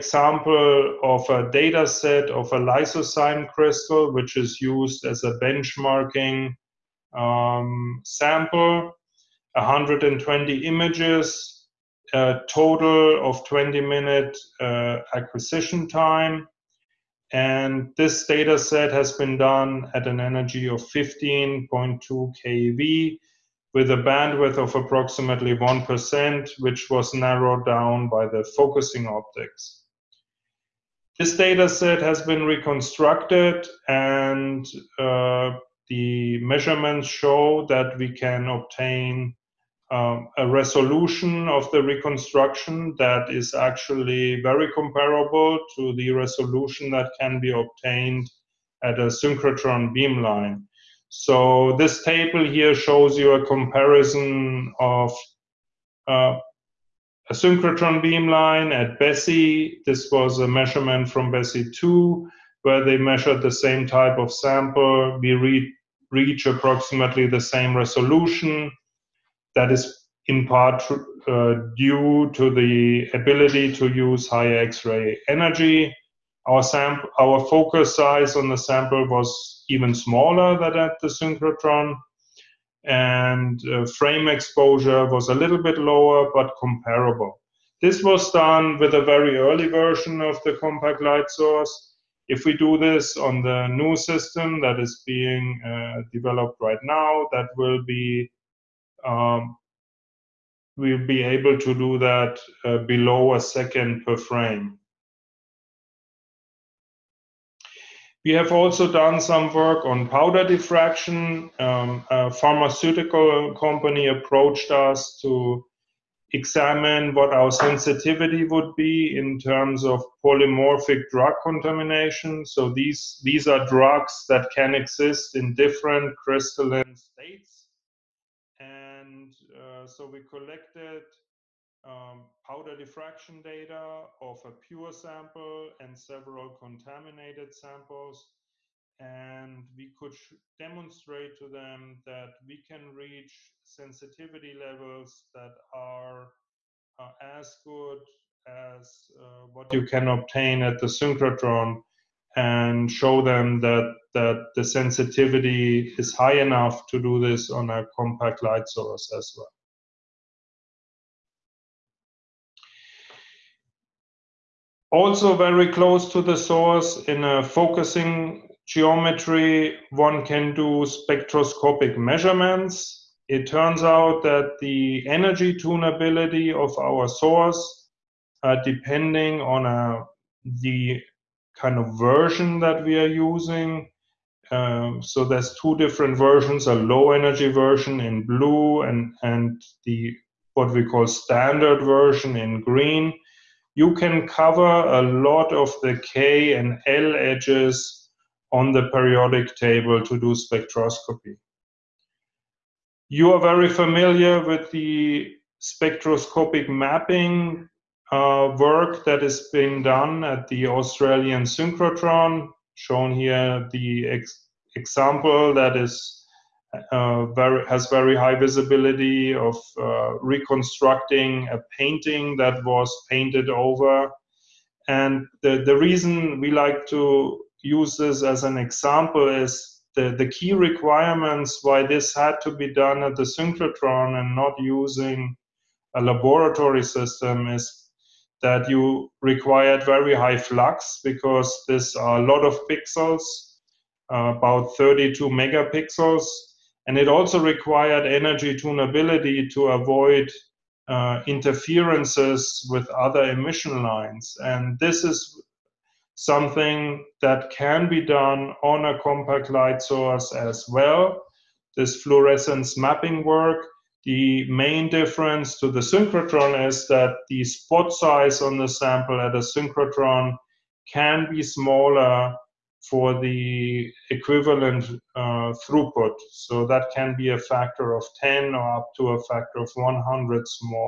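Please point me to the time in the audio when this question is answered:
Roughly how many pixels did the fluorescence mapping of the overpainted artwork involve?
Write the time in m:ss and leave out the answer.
4:04.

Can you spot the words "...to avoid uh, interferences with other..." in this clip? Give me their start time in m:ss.
4:09.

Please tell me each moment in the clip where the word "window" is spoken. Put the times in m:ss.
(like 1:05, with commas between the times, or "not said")
not said.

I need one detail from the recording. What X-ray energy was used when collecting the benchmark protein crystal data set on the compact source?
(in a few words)
15.2 keV.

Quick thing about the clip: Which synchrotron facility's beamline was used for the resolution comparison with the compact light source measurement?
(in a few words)
BESSY 2.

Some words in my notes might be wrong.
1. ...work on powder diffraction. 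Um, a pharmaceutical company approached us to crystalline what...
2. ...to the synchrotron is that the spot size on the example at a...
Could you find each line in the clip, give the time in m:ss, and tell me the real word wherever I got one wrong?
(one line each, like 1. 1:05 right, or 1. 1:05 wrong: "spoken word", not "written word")
1. 1:49 wrong: "examine", not "crystalline"
2. 4:25 wrong: "sample", not "example".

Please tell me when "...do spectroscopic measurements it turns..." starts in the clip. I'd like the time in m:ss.
2:50.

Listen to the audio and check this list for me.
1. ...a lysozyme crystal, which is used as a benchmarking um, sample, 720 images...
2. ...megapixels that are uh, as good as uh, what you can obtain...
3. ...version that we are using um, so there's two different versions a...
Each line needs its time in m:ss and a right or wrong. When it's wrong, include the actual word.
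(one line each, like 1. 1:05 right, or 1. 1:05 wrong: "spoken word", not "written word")
1. 0:02 wrong: "120", not "720"
2. 2:24 wrong: "levels", not "megapixels"
3. 3:01 right.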